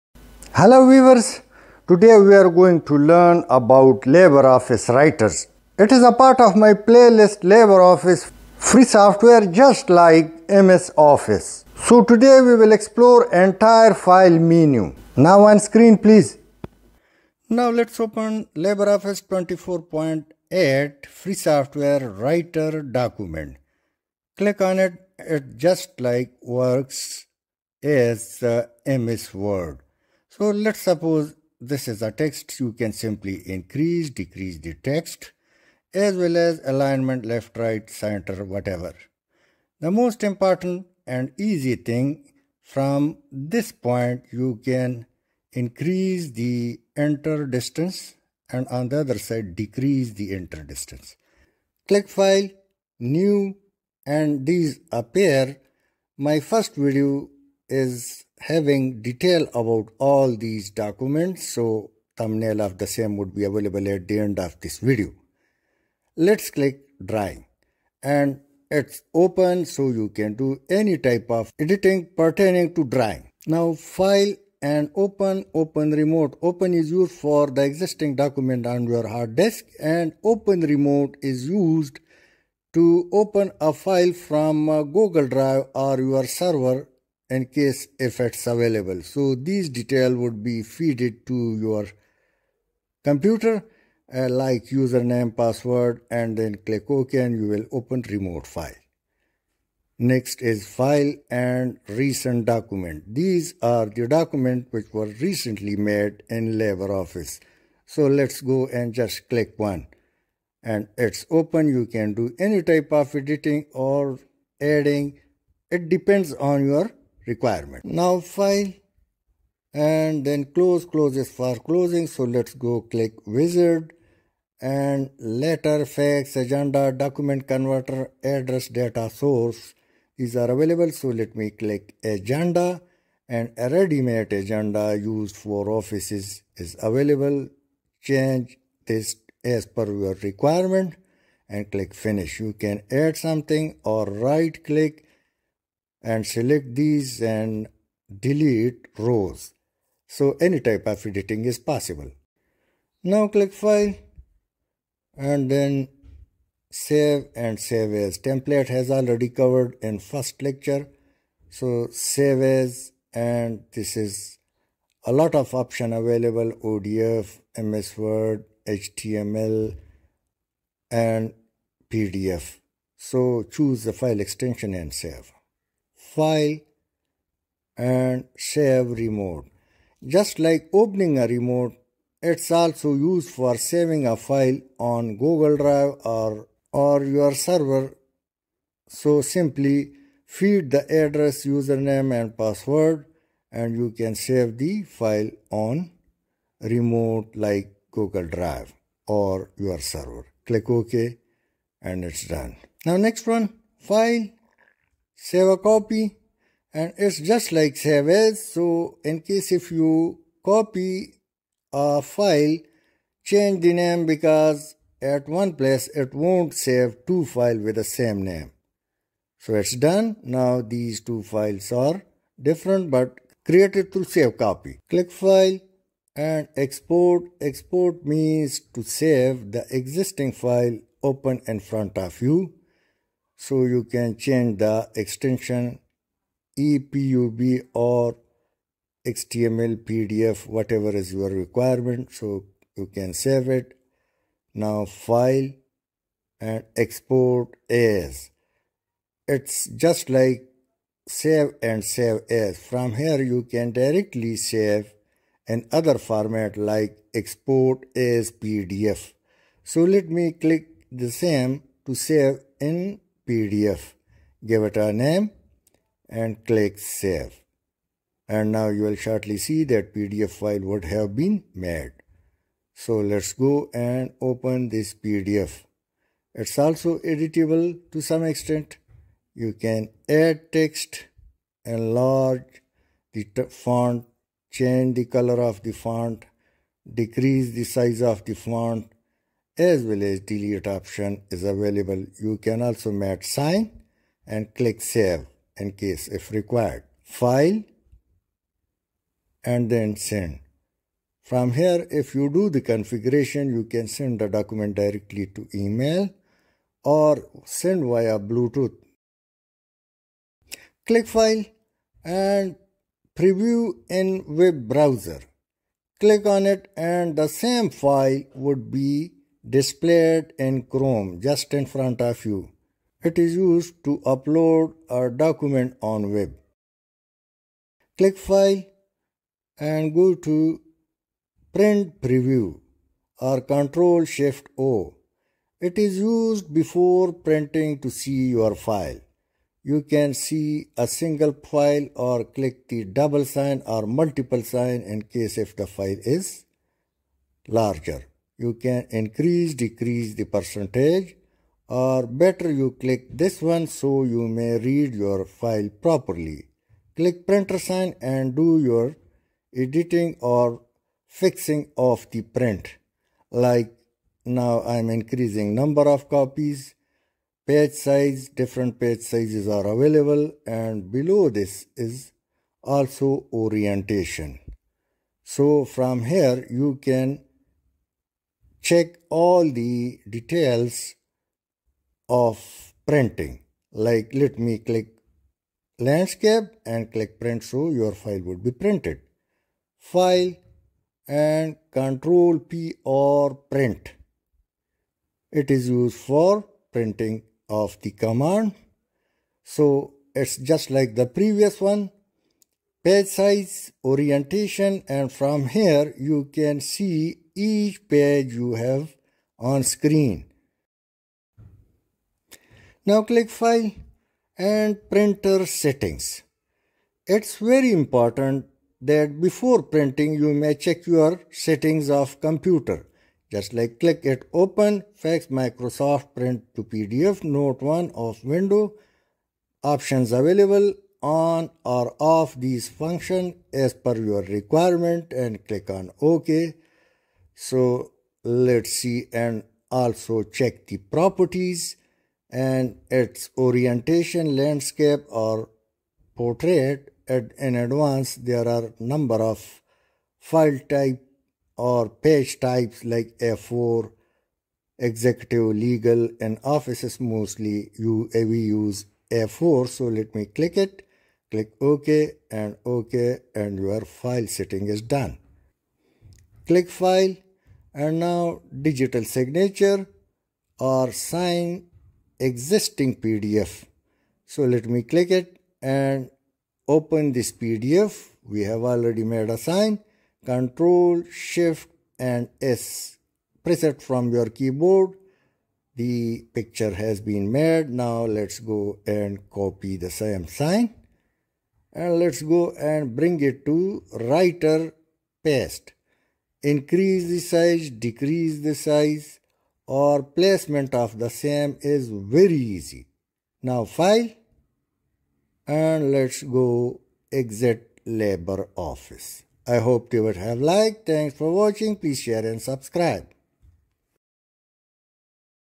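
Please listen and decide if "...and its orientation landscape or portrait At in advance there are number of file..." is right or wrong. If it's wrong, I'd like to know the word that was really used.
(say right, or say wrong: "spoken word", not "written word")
right.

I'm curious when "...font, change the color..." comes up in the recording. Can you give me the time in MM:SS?
04:43.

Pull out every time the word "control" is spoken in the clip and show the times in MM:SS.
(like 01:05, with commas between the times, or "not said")
05:33, 06:31, 08:00.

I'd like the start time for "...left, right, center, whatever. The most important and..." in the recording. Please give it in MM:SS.
00:37.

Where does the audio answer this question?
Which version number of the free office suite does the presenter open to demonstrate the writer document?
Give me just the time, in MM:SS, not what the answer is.
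00:19.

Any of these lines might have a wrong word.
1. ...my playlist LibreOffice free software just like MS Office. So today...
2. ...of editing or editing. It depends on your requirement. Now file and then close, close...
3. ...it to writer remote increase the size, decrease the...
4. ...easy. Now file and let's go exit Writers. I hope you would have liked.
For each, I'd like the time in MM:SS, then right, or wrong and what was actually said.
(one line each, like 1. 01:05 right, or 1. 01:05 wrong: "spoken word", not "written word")
1. 00:06 right
2. 01:52 wrong: "adding", not "editing"
3. 08:13 wrong: "paste", not "remote"
4. 08:22 wrong: "LibreOffice", not "Writers".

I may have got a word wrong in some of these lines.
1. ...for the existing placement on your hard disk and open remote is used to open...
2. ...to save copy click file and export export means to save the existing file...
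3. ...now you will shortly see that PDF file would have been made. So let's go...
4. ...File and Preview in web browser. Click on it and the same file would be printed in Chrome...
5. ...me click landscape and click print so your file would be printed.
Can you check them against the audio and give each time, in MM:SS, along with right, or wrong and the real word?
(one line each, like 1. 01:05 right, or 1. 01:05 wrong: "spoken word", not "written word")
1. 01:17 wrong: "document", not "placement"
2. 03:43 right
3. 04:28 right
4. 05:11 wrong: "displayed", not "printed"
5. 06:24 right.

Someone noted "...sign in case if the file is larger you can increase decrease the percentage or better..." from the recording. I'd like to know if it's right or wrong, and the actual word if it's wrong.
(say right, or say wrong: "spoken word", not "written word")
right.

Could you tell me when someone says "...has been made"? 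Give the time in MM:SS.
08:06.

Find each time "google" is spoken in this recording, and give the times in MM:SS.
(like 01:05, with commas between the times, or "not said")
01:24, 03:05, 03:17.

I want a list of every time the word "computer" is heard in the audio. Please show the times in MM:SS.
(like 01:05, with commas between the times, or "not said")
01:33, 07:02.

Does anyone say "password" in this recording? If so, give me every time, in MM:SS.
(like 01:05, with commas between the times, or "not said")
01:35, 03:12.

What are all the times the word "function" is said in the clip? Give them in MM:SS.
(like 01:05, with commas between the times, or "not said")
07:12.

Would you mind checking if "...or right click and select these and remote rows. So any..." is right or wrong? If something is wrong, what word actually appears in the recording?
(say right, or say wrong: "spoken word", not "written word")
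wrong: "delete", not "remote".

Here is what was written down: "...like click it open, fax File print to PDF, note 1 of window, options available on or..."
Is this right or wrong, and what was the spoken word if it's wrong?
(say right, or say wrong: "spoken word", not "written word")
wrong: "Microsoft", not "File".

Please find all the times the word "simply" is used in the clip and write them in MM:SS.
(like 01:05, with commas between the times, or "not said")
00:32, 03:09.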